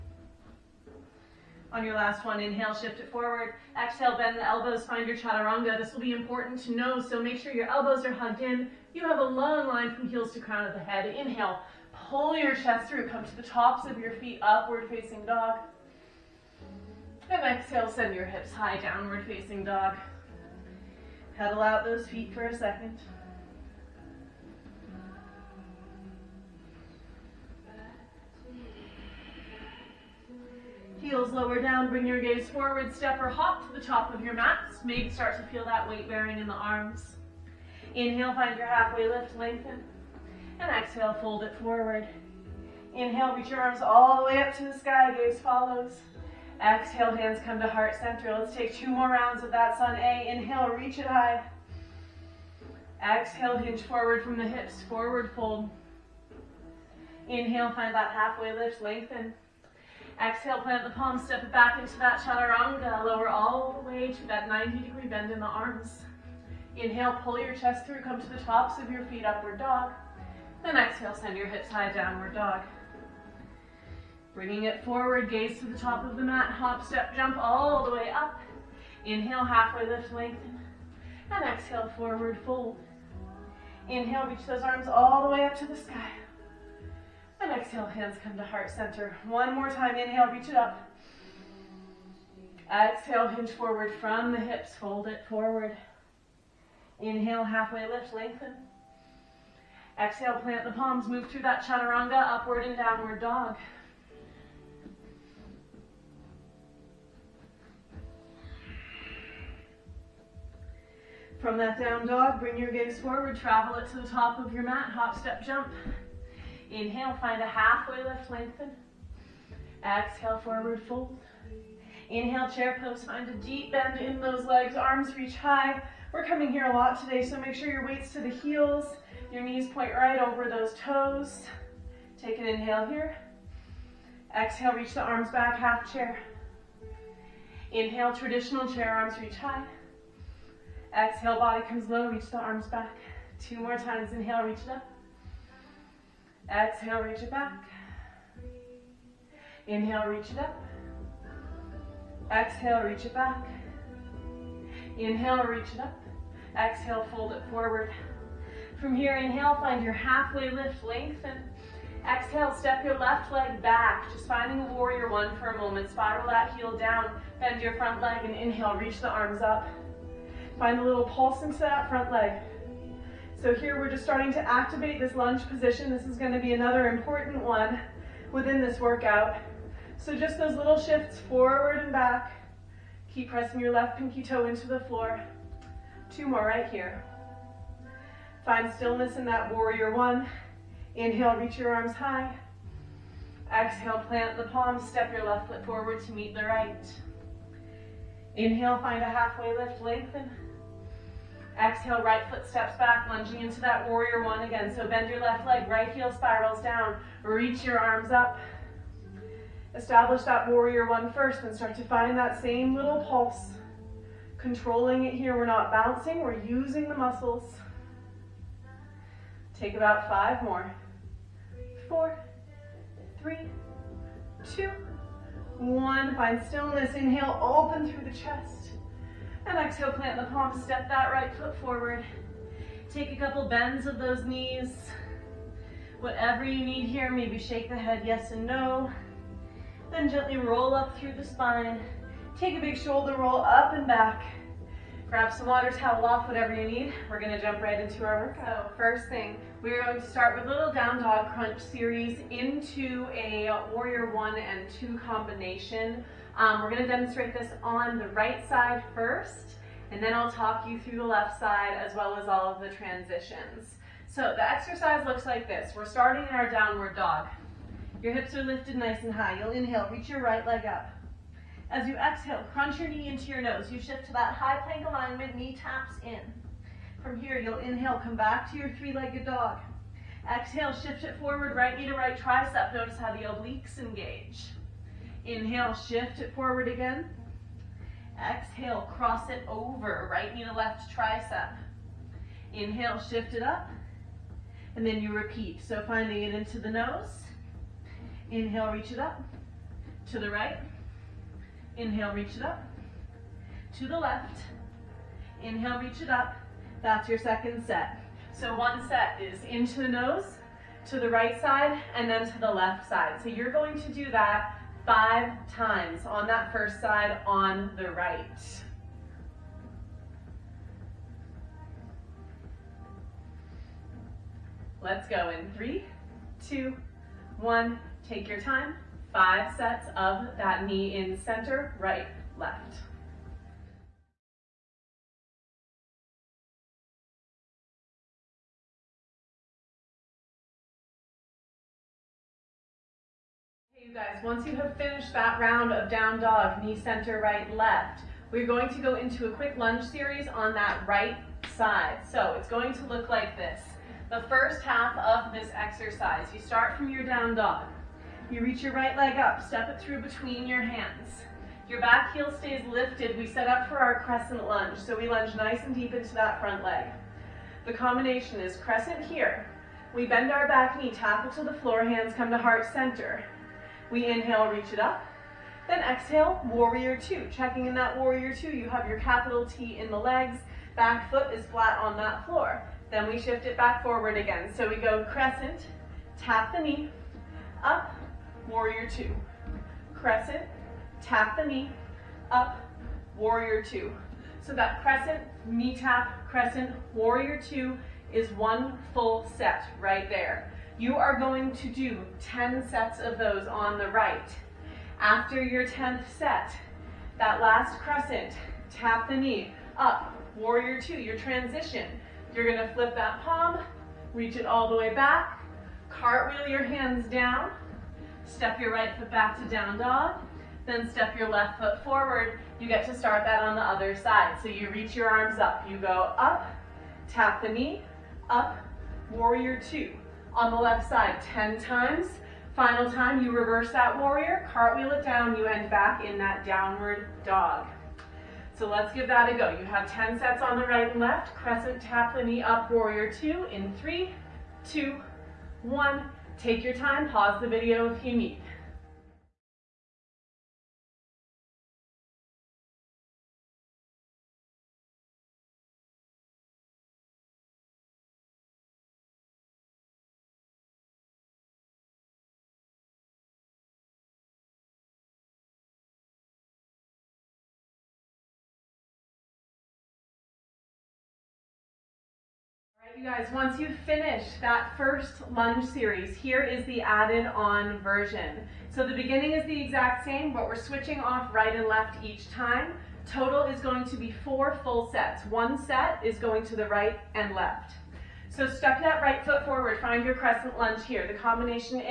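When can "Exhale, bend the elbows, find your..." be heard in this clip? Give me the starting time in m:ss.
0:03.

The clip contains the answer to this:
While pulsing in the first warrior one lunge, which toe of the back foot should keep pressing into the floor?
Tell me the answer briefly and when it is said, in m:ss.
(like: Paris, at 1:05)
left pinky toe, at 3:03.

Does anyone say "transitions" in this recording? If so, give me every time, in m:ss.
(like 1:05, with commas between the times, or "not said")
4:22, 6:51.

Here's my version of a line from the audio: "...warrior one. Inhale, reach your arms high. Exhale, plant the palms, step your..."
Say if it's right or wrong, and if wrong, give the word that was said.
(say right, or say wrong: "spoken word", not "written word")
right.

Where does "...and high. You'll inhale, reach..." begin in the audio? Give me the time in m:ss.
4:29.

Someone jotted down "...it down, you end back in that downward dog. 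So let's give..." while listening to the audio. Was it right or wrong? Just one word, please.
right.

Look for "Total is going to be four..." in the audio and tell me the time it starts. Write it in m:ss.
8:03.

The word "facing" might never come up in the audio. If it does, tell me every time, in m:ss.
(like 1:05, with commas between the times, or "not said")
0:14, 0:19.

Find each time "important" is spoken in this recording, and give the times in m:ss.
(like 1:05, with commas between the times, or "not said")
0:06, 2:56.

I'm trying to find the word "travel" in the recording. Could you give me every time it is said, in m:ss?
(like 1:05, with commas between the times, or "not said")
1:53.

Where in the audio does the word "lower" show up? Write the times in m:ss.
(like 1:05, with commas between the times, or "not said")
0:31, 1:03.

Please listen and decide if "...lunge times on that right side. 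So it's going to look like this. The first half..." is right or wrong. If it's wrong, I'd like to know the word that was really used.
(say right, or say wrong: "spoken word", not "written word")
wrong: "series", not "times".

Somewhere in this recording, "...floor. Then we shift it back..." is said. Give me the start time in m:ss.
6:22.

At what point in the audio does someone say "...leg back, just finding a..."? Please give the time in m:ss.
2:43.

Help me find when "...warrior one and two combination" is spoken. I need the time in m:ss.
4:13.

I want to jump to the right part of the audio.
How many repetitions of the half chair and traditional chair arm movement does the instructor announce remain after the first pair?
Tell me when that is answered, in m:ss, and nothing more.
2:23.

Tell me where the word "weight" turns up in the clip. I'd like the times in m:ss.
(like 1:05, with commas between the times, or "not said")
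0:35, 2:07.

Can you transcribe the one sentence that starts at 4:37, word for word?
From here, you'll inhale, come back to your three-legged dog.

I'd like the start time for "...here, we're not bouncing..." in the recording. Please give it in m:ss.
3:35.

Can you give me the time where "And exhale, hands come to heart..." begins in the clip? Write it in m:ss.
1:27.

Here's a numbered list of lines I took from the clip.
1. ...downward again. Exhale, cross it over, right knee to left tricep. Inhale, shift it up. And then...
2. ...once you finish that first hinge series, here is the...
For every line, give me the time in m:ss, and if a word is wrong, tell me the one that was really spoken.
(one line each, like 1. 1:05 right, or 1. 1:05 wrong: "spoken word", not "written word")
1. 4:46 wrong: "forward", not "downward"
2. 7:53 wrong: "lunge", not "hinge".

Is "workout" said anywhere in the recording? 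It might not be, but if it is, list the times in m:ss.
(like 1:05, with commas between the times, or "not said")
2:58, 4:08.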